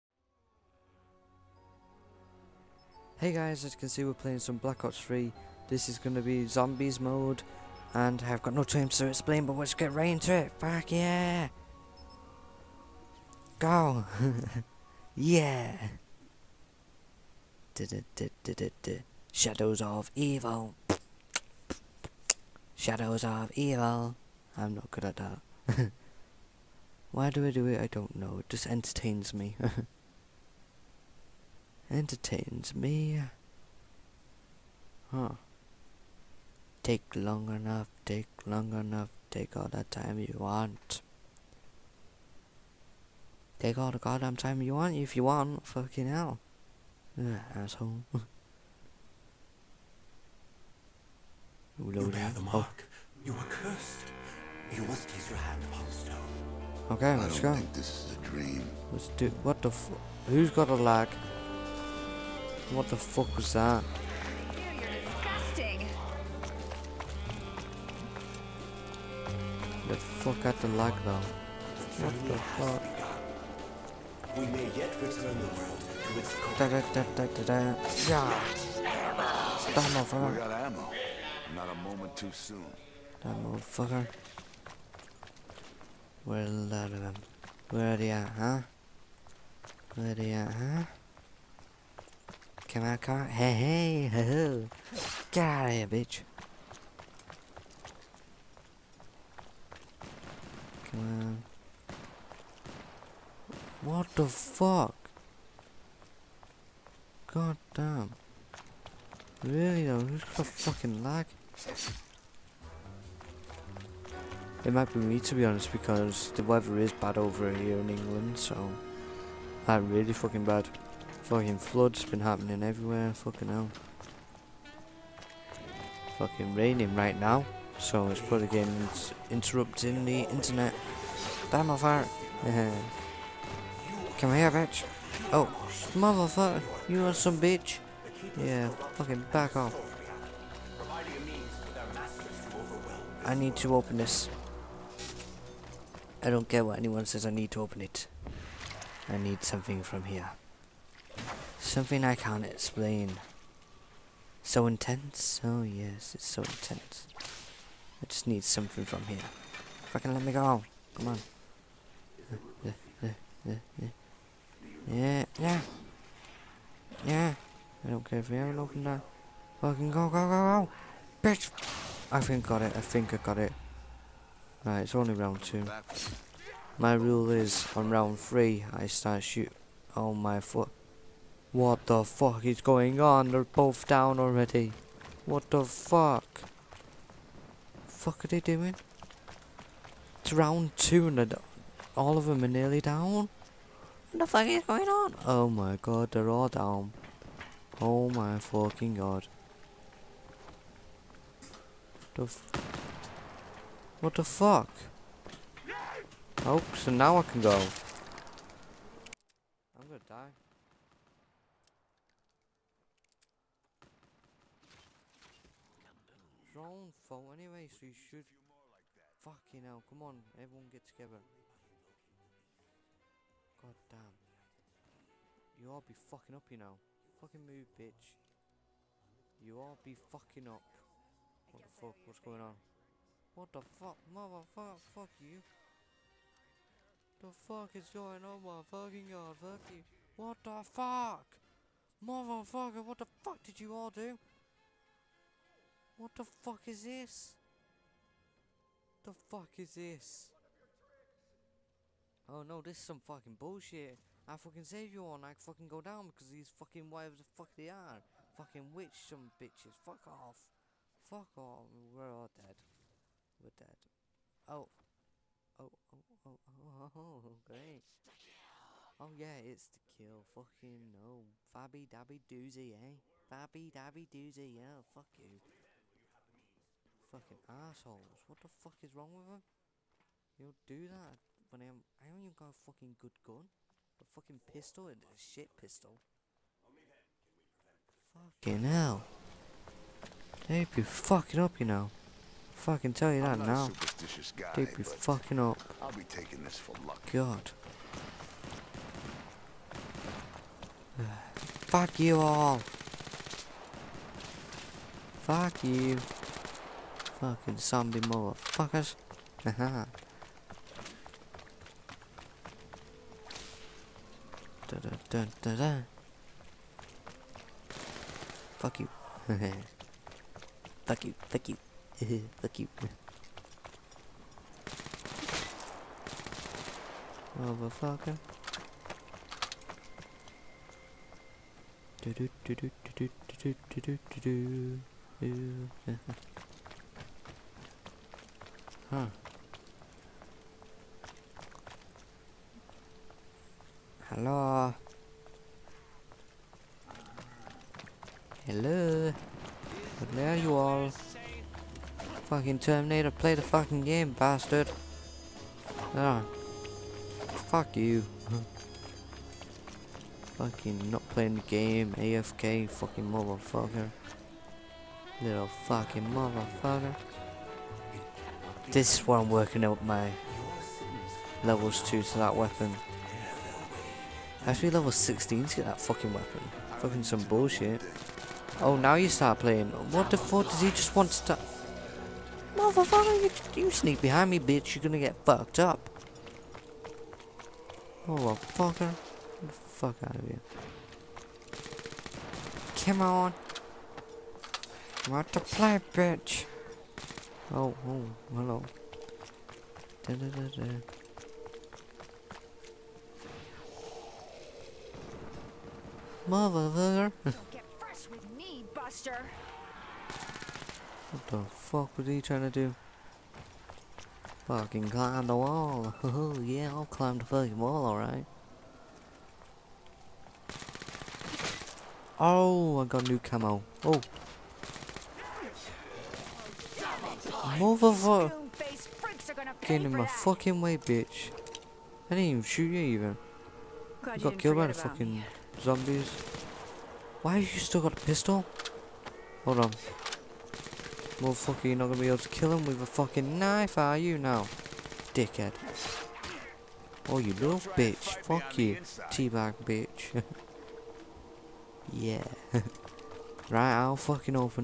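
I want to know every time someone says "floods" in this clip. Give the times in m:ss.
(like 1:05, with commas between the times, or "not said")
2:01.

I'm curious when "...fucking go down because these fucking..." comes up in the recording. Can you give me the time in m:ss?
4:15.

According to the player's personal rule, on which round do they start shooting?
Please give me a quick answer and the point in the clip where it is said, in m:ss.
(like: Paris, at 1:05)
Round 3, at 2:57.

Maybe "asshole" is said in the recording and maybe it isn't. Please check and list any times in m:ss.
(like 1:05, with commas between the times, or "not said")
0:47, 4:37.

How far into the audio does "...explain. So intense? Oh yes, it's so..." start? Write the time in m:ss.
2:32.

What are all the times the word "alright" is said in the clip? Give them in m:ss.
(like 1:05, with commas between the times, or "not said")
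6:57.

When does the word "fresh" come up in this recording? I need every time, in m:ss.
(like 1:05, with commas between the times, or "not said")
6:47.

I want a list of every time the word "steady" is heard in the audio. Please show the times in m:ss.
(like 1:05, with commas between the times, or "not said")
not said.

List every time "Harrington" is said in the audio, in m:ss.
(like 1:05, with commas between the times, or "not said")
not said.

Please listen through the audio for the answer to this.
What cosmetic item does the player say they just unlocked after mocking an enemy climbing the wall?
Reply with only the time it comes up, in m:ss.
7:03.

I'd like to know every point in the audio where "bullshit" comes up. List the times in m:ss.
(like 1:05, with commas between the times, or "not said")
4:13, 6:17.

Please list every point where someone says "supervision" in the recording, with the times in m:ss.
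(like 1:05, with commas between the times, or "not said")
not said.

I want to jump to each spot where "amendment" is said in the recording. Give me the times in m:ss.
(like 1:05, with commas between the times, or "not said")
not said.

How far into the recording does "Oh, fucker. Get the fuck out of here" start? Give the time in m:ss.
6:28.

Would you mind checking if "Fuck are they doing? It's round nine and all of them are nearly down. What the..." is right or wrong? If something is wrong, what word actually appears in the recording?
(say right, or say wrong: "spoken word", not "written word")
wrong: "two", not "nine".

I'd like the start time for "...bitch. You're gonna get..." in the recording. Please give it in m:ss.
6:24.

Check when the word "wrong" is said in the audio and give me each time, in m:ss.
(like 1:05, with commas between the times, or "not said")
4:38.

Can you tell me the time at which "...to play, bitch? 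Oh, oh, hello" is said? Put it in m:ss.
6:35.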